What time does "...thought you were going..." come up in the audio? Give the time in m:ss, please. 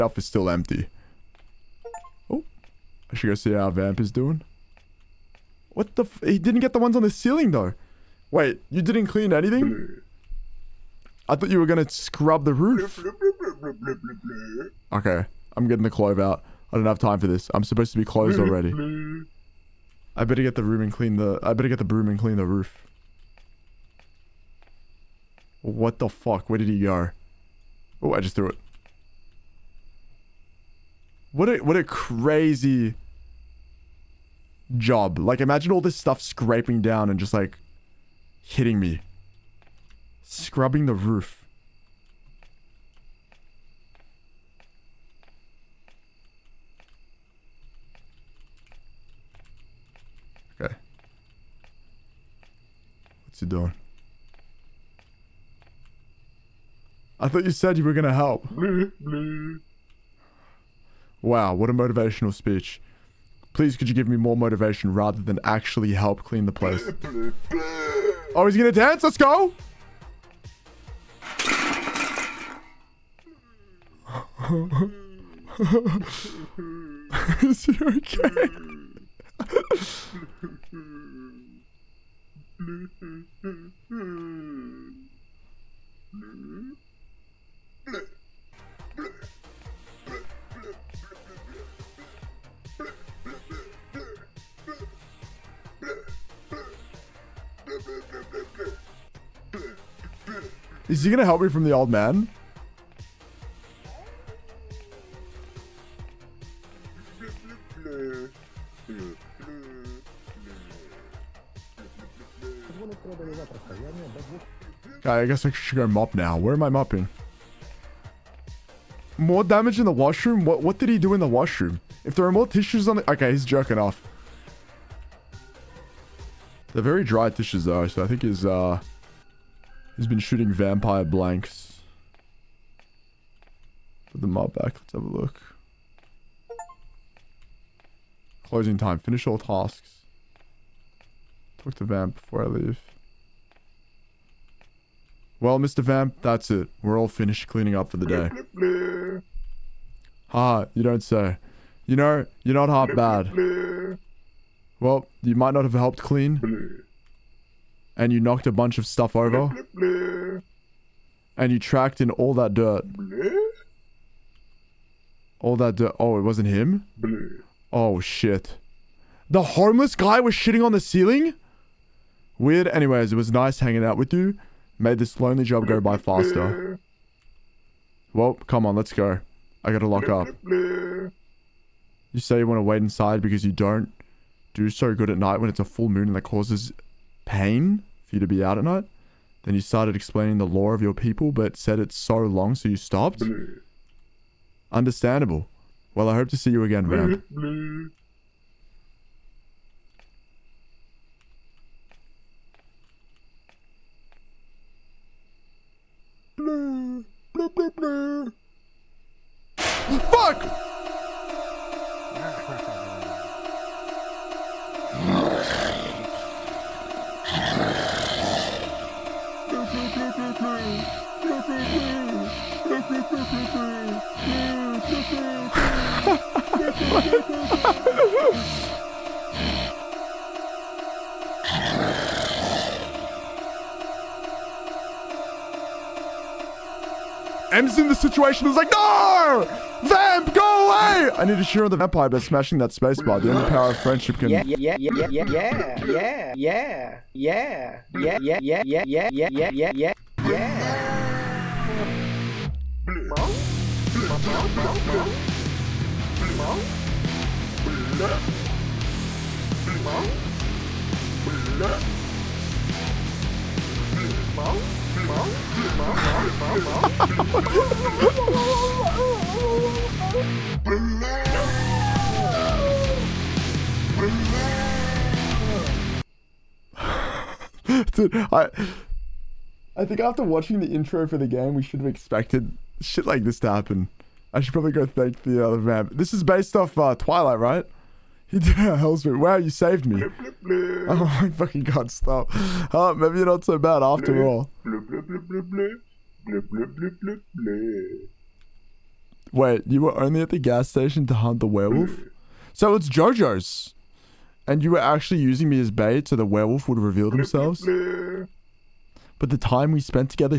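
0:11.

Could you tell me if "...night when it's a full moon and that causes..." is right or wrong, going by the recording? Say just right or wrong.
right.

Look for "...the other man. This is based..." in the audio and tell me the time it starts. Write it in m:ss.
4:45.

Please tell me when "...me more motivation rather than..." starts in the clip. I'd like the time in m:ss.
1:04.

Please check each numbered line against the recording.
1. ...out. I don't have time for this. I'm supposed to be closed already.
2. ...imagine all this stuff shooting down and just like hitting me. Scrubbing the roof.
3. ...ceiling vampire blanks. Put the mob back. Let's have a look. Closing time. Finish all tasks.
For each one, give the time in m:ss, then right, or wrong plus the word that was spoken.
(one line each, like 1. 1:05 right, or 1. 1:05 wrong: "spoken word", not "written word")
1. 0:16 right
2. 0:35 wrong: "scraping", not "shooting"
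3. 2:10 wrong: "shooting", not "ceiling".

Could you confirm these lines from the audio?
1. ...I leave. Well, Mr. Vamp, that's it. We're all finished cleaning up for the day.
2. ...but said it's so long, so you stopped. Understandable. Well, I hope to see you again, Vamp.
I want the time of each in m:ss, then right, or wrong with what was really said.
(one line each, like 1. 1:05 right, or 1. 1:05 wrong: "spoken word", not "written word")
1. 2:22 right
2. 3:11 right.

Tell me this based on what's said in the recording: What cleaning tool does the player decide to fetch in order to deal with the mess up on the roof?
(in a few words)
Broom.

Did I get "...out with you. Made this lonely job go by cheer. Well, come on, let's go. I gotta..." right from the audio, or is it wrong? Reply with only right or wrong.
wrong.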